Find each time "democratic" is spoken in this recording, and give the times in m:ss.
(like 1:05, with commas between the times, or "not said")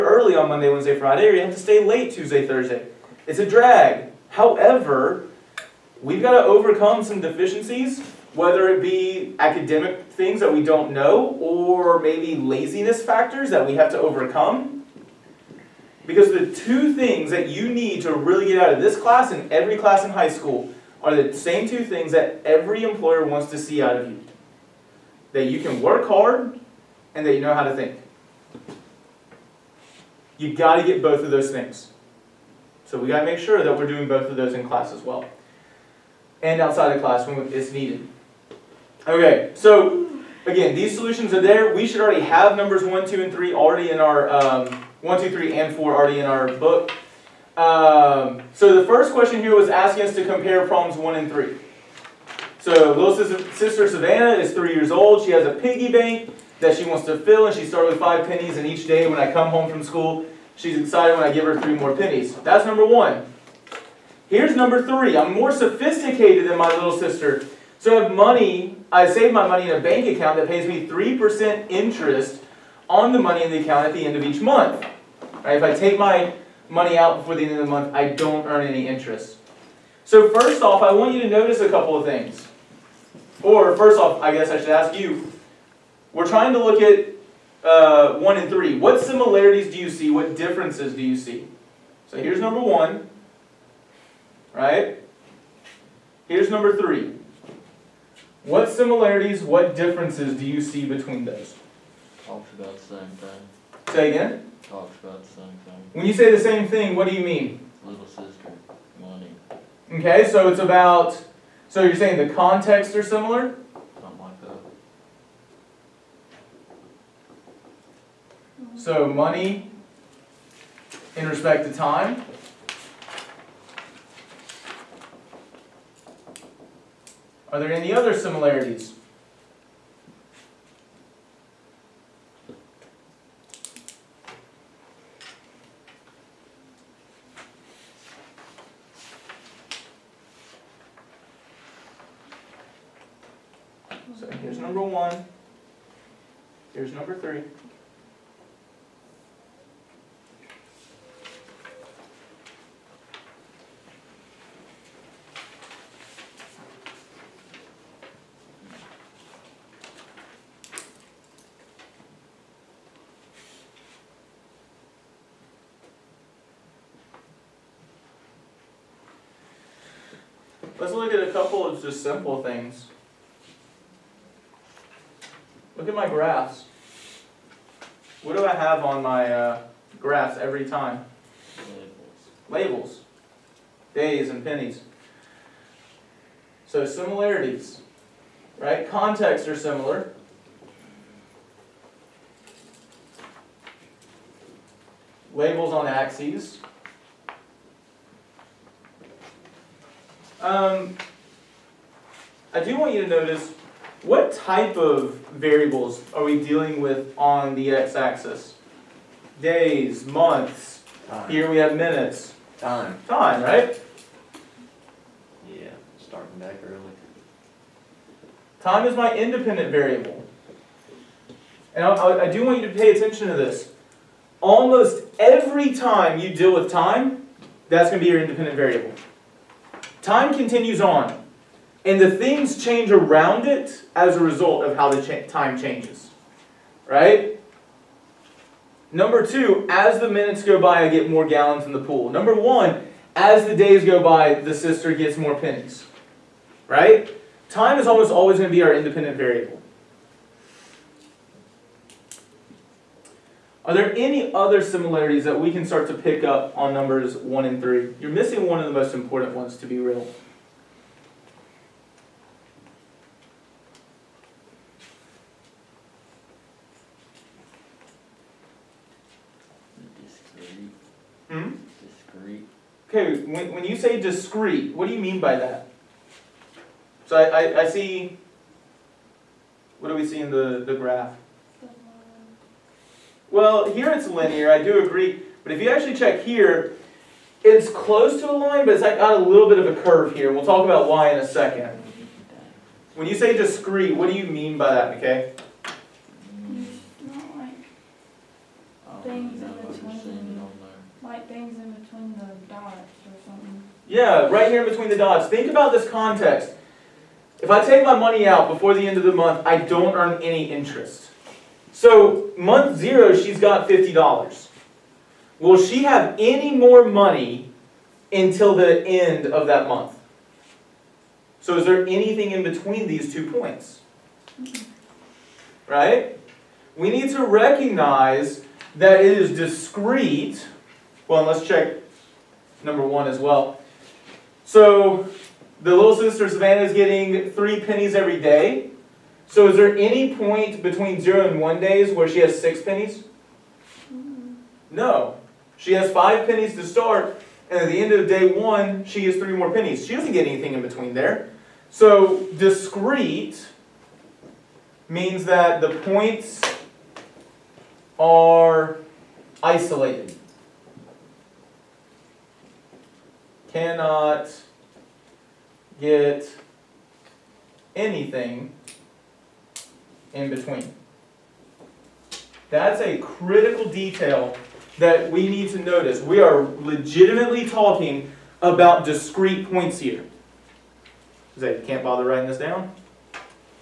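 not said.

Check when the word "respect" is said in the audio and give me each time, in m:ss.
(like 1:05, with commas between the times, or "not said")
2:01.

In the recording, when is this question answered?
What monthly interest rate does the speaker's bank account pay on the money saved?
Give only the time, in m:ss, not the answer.
1:10.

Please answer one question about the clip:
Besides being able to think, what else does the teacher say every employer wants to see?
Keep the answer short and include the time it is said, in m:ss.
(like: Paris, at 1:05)
work hard, at 0:25.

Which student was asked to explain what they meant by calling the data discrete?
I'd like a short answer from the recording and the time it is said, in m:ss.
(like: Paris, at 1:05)
McKay, at 4:55.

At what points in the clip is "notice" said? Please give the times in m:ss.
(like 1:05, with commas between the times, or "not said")
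1:21, 3:23, 6:15.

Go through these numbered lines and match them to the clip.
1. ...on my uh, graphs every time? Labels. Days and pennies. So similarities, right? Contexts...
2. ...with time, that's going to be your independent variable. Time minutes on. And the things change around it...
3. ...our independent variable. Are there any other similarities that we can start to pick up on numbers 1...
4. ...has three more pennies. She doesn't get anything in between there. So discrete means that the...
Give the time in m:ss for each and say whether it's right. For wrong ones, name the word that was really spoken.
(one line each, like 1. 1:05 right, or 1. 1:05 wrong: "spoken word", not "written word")
1. 2:58 right
2. 3:46 wrong: "continues", not "minutes"
3. 4:08 right
4. 5:49 right.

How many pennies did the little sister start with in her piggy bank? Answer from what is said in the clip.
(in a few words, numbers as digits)
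5.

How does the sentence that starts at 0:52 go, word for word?
So little sister, sister Savannah is 3 years old.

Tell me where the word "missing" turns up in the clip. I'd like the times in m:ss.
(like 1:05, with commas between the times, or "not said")
4:18.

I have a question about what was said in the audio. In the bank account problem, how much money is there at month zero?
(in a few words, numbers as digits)
$50.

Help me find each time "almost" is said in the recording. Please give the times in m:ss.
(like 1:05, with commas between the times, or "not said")
3:44, 4:07.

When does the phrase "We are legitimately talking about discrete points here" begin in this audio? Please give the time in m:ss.
6:16.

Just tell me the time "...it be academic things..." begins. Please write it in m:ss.
0:08.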